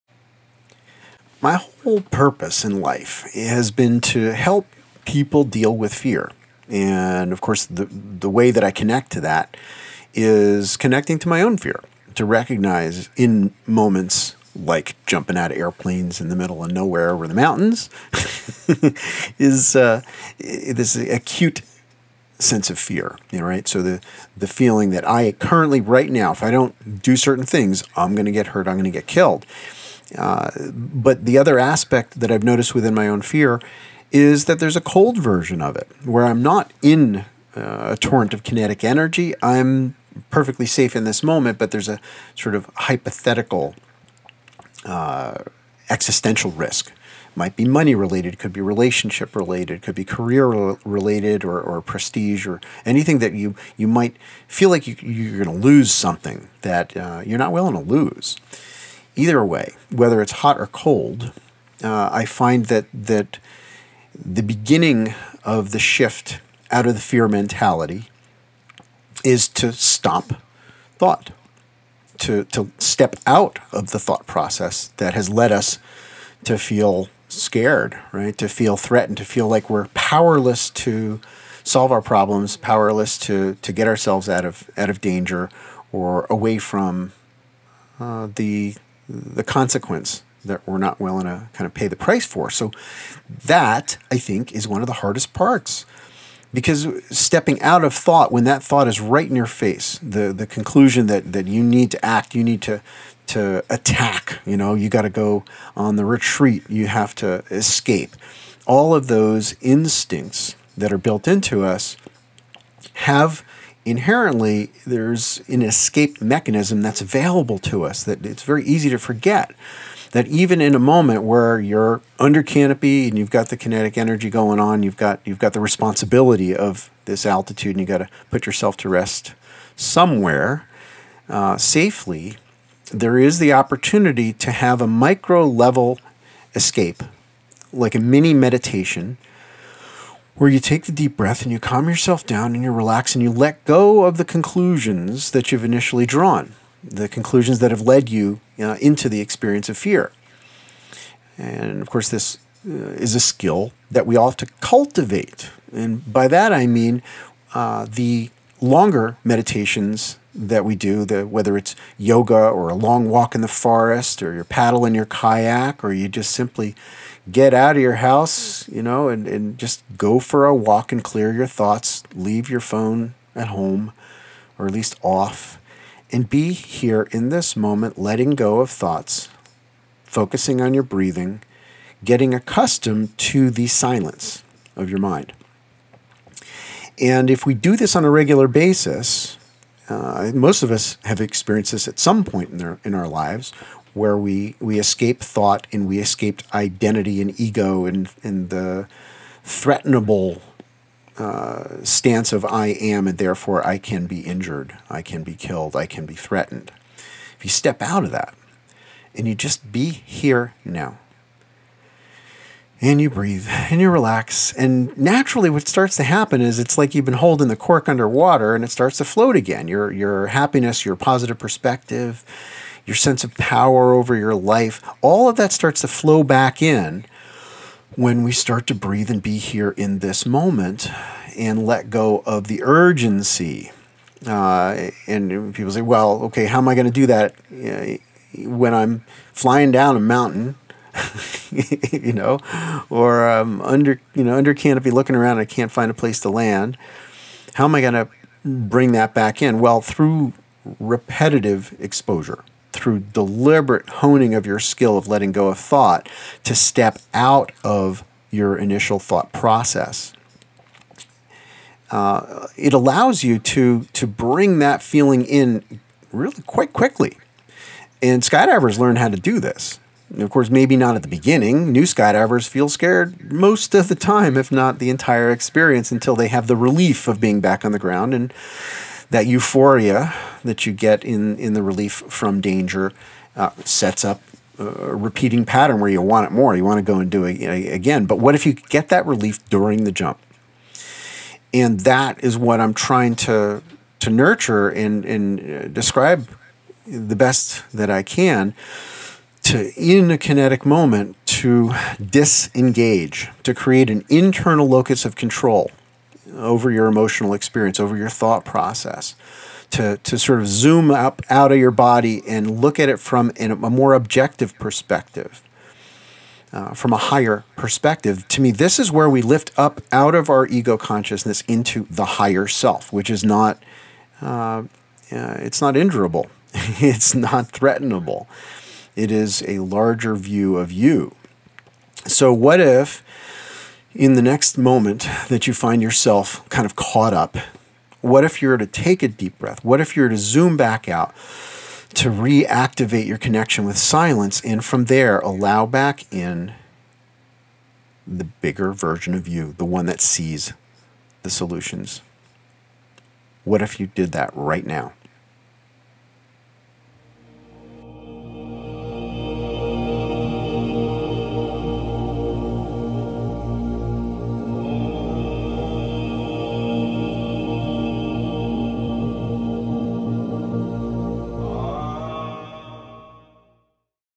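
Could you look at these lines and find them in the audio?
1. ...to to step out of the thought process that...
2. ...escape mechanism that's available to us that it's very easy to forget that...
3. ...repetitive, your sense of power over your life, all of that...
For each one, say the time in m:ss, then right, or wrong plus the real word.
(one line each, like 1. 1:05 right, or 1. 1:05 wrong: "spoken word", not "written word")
1. 1:12 right
2. 1:55 right
3. 3:41 wrong: "perspective", not "repetitive".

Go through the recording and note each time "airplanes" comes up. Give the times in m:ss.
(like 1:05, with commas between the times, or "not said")
0:15.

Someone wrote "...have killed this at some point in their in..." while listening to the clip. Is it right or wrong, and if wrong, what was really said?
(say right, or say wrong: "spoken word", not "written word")
wrong: "experienced", not "killed".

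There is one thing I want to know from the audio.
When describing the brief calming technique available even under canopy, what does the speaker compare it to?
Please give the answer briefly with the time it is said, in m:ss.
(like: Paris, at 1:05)
a mini meditation, at 2:17.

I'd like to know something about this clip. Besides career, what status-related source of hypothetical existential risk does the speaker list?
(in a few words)
prestige.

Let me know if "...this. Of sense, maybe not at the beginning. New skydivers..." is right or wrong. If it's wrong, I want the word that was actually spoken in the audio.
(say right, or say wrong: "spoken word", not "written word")
wrong: "course", not "sense".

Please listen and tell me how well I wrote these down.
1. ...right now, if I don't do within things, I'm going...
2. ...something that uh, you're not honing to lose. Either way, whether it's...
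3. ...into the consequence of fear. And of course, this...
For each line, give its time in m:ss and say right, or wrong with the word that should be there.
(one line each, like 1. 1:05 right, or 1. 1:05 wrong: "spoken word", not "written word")
1. 0:25 wrong: "certain", not "within"
2. 0:55 wrong: "willing", not "honing"
3. 2:28 wrong: "experience", not "consequence".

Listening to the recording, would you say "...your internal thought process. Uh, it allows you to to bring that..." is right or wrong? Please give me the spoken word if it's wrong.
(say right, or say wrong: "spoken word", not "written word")
wrong: "initial", not "internal".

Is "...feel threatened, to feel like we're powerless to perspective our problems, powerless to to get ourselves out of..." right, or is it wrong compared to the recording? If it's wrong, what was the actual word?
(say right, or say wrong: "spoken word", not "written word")
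wrong: "solve", not "perspective".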